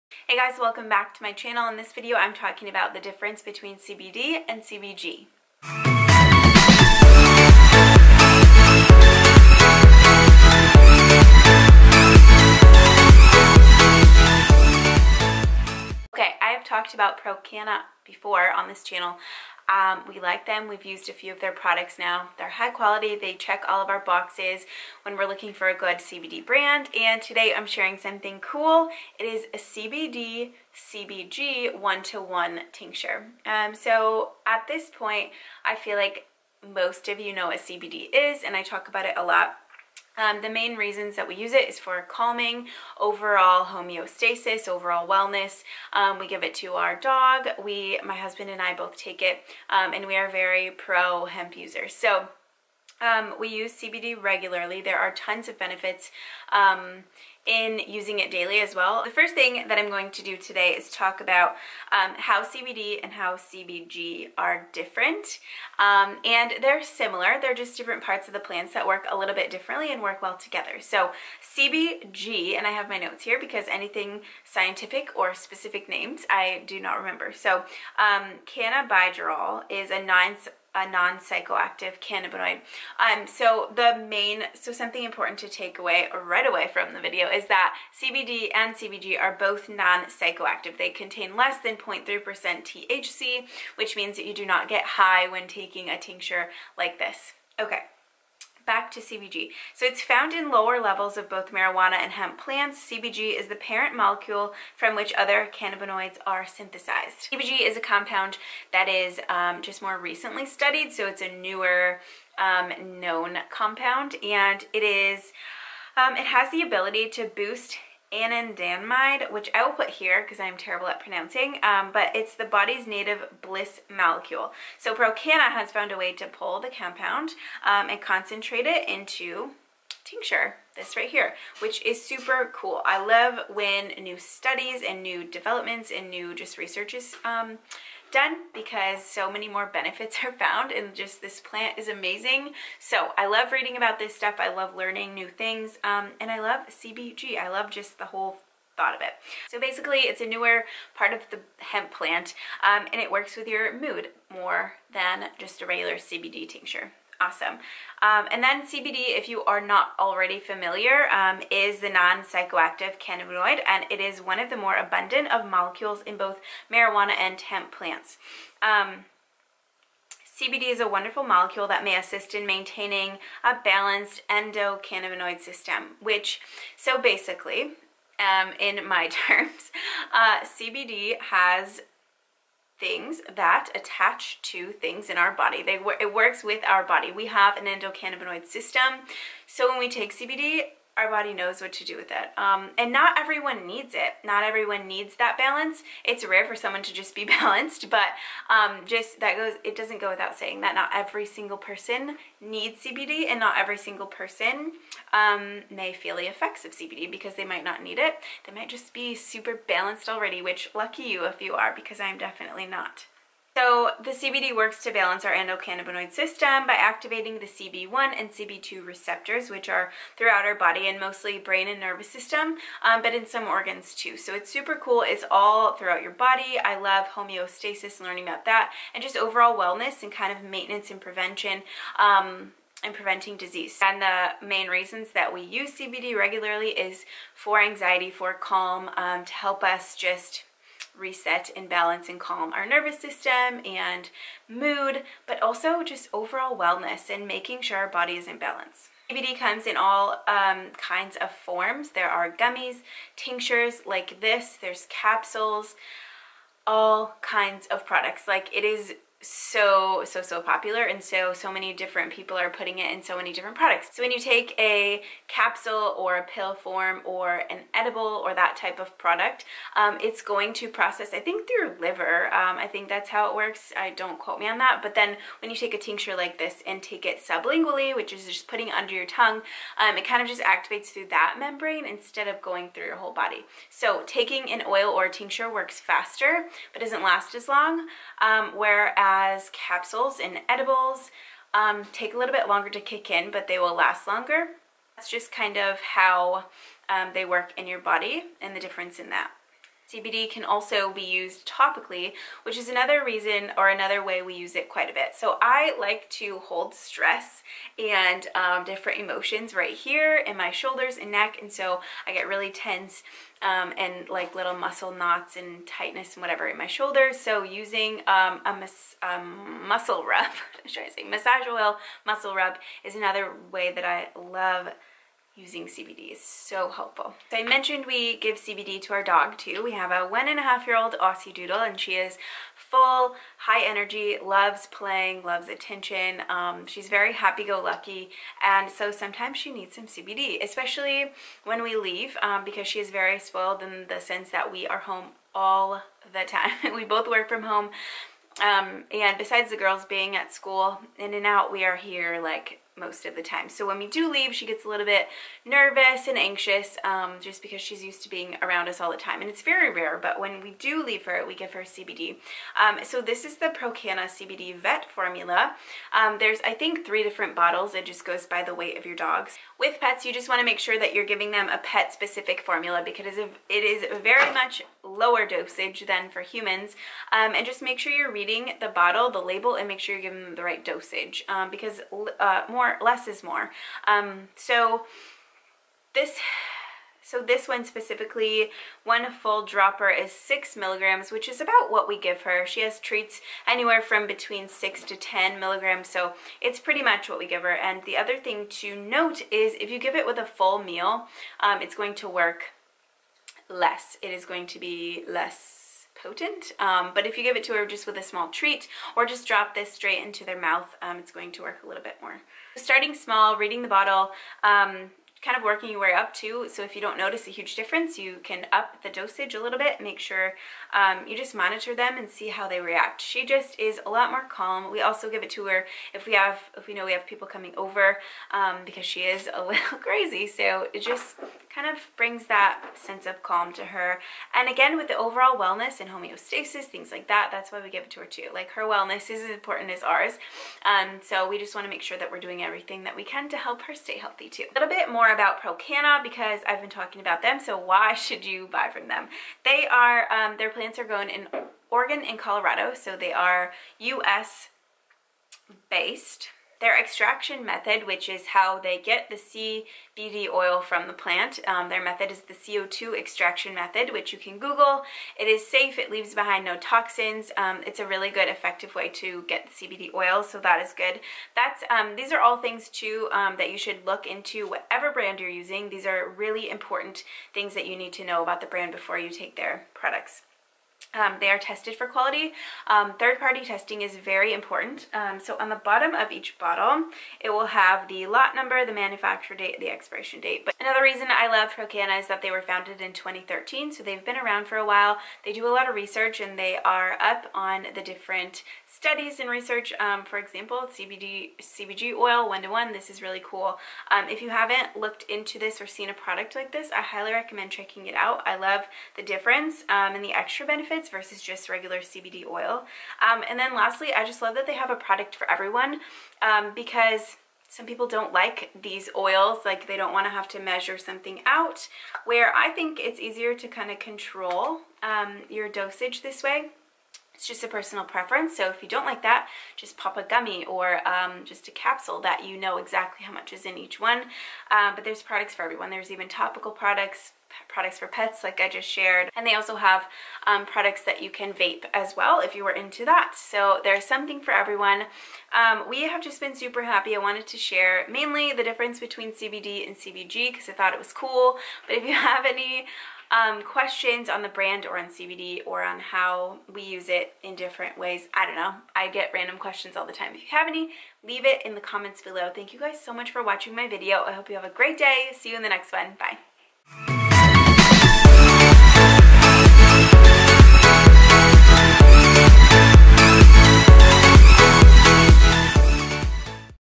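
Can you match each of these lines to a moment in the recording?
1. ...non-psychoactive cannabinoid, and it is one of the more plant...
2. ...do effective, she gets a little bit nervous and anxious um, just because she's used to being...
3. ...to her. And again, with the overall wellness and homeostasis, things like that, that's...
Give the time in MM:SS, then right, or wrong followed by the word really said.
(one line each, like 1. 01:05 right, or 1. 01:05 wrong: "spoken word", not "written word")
1. 02:41 wrong: "abundant", not "plant"
2. 05:53 wrong: "leave", not "effective"
3. 07:13 right.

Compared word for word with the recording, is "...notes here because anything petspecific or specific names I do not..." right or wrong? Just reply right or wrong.
wrong.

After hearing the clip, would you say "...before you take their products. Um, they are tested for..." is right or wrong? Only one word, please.
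right.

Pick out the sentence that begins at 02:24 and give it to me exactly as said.
I love learning new things um, and I love CBG.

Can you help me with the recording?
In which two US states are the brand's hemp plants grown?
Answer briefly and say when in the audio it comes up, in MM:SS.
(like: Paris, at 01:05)
Oregon and Colorado, at 07:31.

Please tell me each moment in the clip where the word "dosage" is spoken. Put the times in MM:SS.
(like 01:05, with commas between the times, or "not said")
06:15, 06:20, 06:58, 08:45.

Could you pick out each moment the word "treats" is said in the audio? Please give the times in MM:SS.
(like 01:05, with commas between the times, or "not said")
06:32, 06:48.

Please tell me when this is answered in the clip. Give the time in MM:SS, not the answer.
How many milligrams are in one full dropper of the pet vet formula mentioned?
06:30.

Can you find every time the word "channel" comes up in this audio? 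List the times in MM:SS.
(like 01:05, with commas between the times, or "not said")
00:01, 00:18.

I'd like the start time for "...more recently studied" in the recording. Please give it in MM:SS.
01:49.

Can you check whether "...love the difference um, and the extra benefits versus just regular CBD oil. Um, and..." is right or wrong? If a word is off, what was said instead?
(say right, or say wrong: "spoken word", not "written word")
right.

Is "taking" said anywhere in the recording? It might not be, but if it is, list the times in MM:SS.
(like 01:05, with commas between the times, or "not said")
01:35, 04:44.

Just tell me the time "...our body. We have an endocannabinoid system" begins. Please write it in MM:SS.
03:06.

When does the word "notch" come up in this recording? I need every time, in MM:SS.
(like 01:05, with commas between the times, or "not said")
not said.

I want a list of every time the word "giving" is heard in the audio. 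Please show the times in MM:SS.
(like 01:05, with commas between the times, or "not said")
06:11, 06:20.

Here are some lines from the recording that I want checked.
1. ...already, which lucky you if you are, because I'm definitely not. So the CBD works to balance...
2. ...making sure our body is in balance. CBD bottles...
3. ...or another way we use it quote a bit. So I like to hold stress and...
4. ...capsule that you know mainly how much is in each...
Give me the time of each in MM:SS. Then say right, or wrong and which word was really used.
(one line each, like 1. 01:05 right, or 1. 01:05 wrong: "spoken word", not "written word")
1. 03:30 right
2. 04:07 wrong: "comes", not "bottles"
3. 05:03 wrong: "quite", not "quote"
4. 08:51 wrong: "exactly", not "mainly".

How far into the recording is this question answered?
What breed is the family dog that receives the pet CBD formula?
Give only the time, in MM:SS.
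05:30.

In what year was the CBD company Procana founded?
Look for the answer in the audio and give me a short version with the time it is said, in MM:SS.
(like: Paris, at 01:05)
2013, at 08:12.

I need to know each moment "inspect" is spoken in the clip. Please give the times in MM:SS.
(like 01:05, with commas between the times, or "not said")
not said.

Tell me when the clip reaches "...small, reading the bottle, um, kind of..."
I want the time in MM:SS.
06:52.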